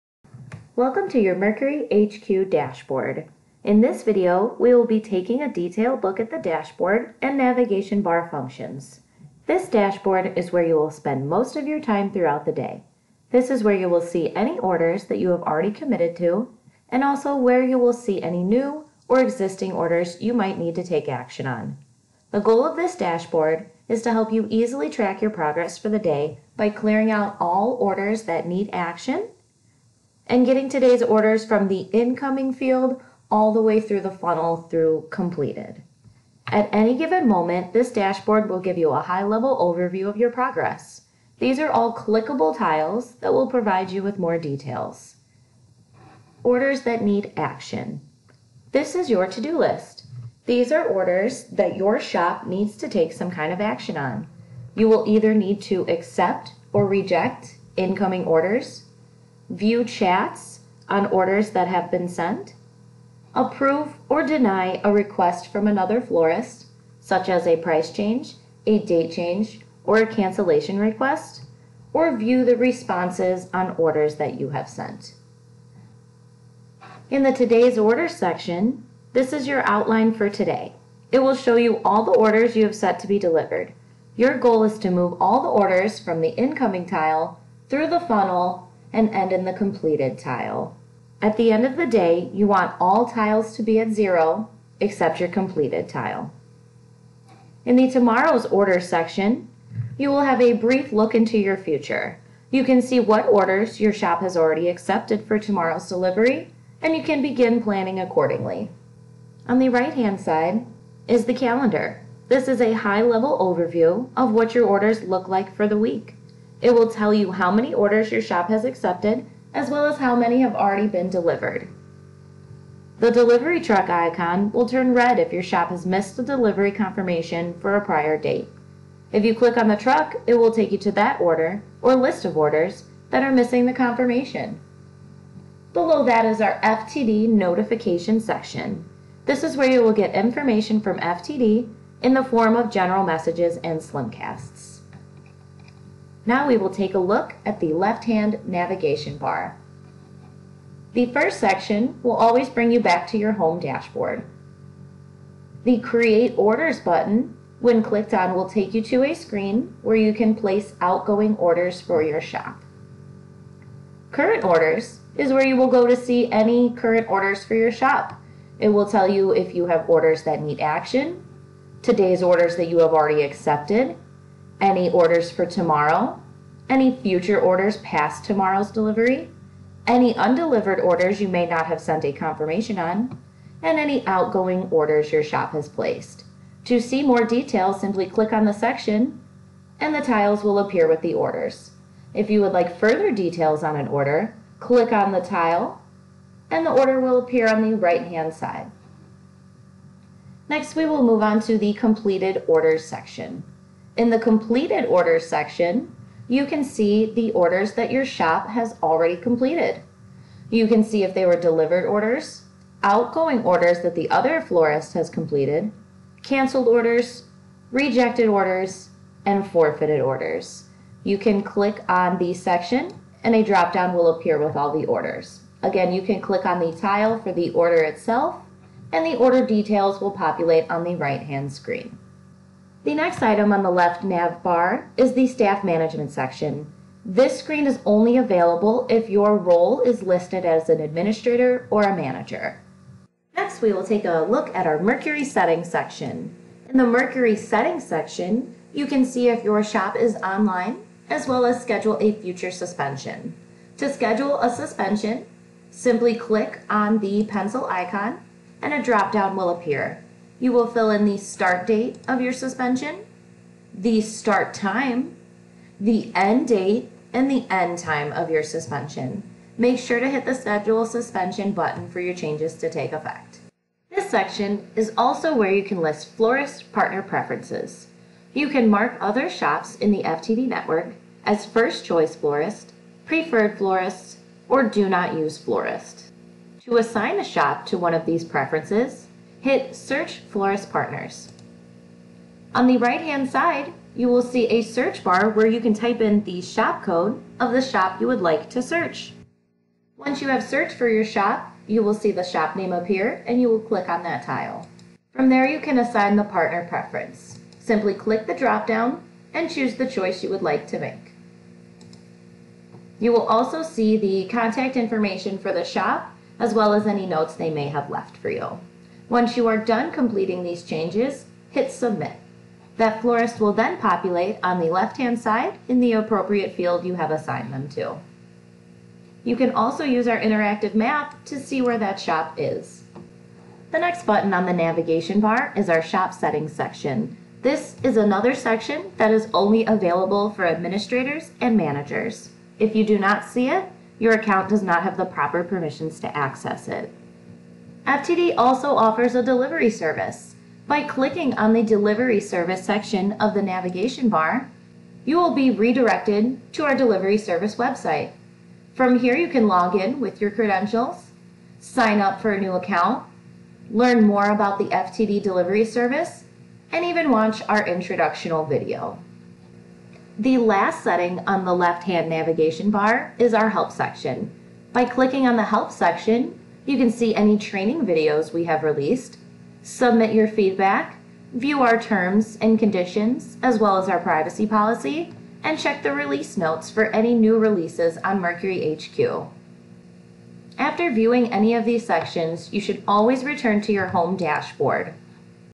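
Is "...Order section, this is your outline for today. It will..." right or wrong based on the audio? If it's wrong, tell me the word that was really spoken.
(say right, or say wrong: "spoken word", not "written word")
right.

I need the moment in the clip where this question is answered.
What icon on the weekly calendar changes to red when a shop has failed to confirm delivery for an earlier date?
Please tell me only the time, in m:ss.
2:03.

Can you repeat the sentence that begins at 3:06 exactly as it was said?
To see more details, simply click on the section and the tiles will appear with the orders.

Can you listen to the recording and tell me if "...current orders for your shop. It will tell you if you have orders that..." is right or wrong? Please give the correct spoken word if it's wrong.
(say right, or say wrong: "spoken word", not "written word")
right.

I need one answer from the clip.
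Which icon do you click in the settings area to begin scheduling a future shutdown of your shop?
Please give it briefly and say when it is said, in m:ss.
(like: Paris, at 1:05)
Pencil icon, at 4:17.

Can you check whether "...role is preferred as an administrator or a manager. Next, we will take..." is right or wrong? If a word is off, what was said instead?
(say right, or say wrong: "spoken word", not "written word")
wrong: "listed", not "preferred".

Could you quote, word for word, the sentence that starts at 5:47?
FTD also offers a delivery service.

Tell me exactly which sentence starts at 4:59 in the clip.
Once you have searched for your shop, you will see the shop name appear and you will click on that tile.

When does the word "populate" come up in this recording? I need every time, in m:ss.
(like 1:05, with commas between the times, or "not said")
3:50, 5:23.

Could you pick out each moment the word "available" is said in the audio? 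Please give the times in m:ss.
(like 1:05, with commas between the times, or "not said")
3:58, 5:39.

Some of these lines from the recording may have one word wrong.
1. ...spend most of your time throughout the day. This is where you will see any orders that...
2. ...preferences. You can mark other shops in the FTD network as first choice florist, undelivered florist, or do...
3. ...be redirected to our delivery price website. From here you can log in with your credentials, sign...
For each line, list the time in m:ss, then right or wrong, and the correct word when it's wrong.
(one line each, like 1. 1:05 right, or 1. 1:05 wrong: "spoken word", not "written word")
1. 0:10 right
2. 4:37 wrong: "preferred", not "undelivered"
3. 5:55 wrong: "service", not "price".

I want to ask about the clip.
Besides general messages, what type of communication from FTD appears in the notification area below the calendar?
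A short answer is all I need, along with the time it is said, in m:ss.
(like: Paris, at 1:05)
Slimcasts, at 2:23.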